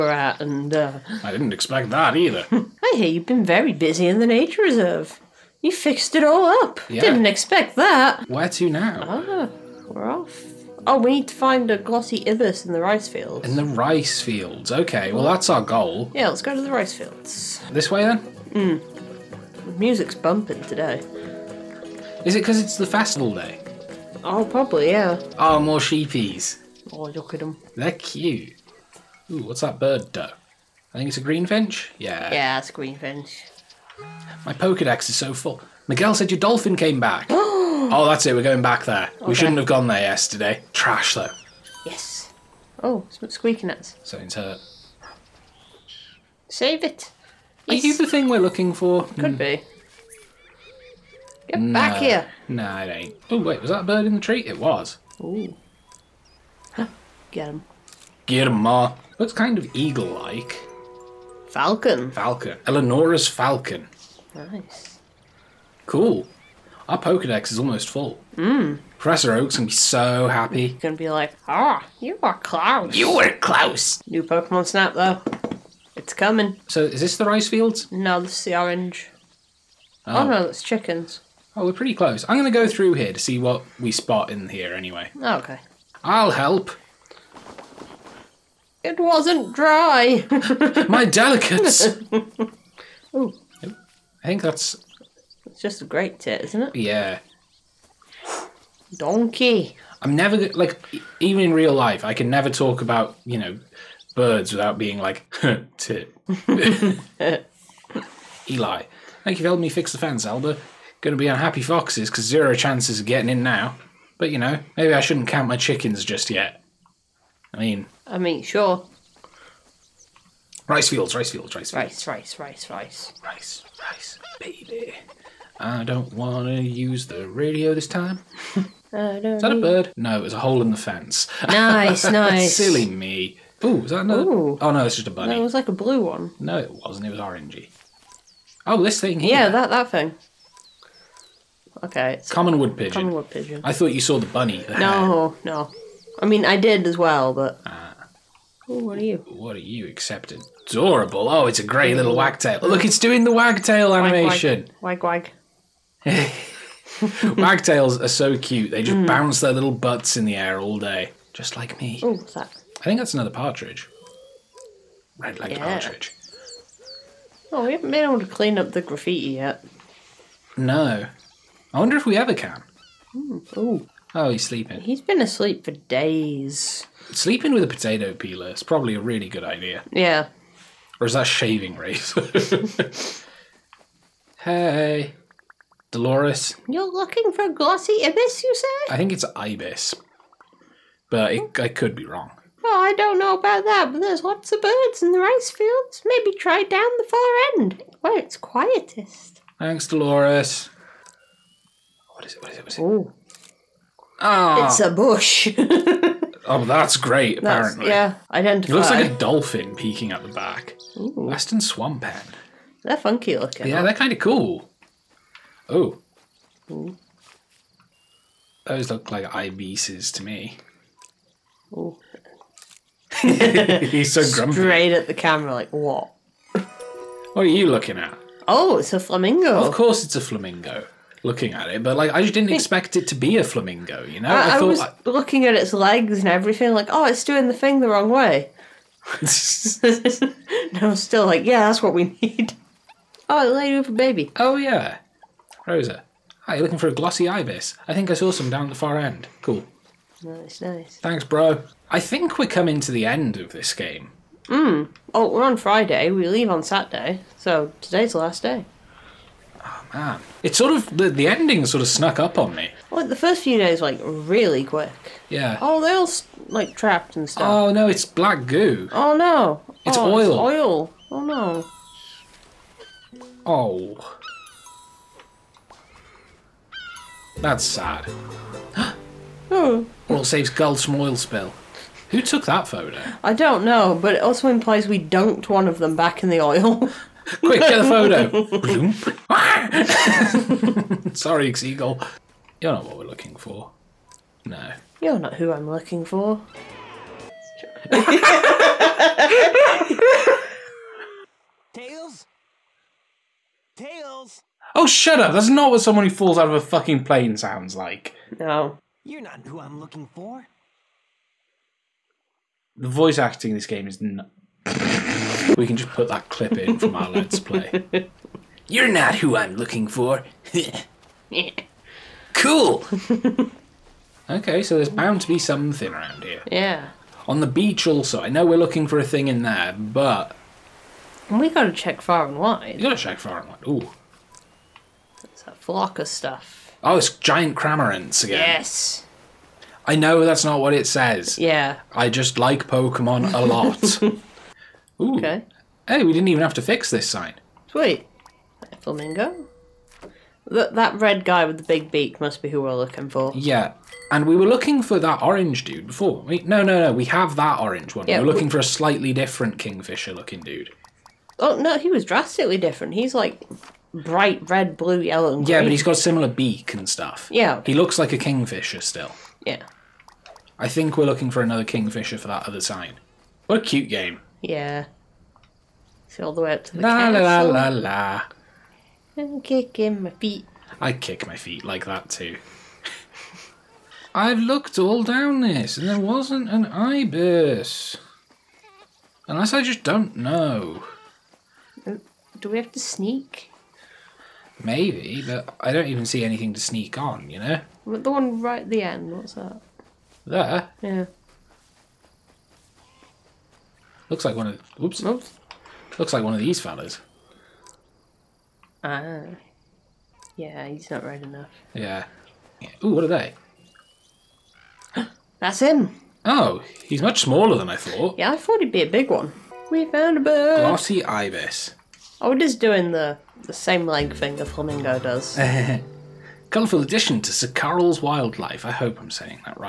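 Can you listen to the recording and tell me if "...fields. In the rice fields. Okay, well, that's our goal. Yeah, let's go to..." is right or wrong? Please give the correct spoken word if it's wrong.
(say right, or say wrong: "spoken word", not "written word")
right.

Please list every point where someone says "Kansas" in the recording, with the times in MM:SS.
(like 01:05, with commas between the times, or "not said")
not said.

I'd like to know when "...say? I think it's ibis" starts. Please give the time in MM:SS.
03:08.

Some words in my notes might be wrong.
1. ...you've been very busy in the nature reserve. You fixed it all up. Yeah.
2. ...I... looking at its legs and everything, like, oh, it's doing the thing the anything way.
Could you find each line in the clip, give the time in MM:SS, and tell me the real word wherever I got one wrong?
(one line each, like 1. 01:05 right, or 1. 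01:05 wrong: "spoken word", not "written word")
1. 00:03 right
2. 03:54 wrong: "wrong", not "anything".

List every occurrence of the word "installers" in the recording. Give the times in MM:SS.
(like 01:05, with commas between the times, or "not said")
not said.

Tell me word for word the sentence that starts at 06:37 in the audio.
But the one right at the end, what's that?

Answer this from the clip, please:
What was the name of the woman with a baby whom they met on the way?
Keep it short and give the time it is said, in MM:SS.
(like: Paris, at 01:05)
Rosa, at 04:05.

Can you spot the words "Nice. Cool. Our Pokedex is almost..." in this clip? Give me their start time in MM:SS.
01:04.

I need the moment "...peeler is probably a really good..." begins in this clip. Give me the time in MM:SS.
02:58.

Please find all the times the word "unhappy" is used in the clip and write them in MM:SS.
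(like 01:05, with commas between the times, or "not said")
01:51.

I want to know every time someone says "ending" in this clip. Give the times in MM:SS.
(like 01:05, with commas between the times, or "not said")
04:21.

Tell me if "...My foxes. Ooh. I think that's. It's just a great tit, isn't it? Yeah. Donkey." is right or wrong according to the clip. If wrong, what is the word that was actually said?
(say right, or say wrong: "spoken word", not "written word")
wrong: "delicates", not "foxes".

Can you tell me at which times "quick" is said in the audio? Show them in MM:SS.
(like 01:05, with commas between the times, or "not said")
04:24, 04:47.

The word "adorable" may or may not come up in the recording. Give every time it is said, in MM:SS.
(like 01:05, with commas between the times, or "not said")
02:30.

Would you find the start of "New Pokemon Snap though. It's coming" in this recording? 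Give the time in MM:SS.
01:14.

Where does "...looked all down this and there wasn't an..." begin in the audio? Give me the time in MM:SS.
06:24.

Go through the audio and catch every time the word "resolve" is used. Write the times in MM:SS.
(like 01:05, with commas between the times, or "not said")
not said.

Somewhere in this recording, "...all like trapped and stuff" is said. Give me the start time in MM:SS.
04:25.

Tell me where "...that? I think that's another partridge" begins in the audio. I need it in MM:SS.
02:42.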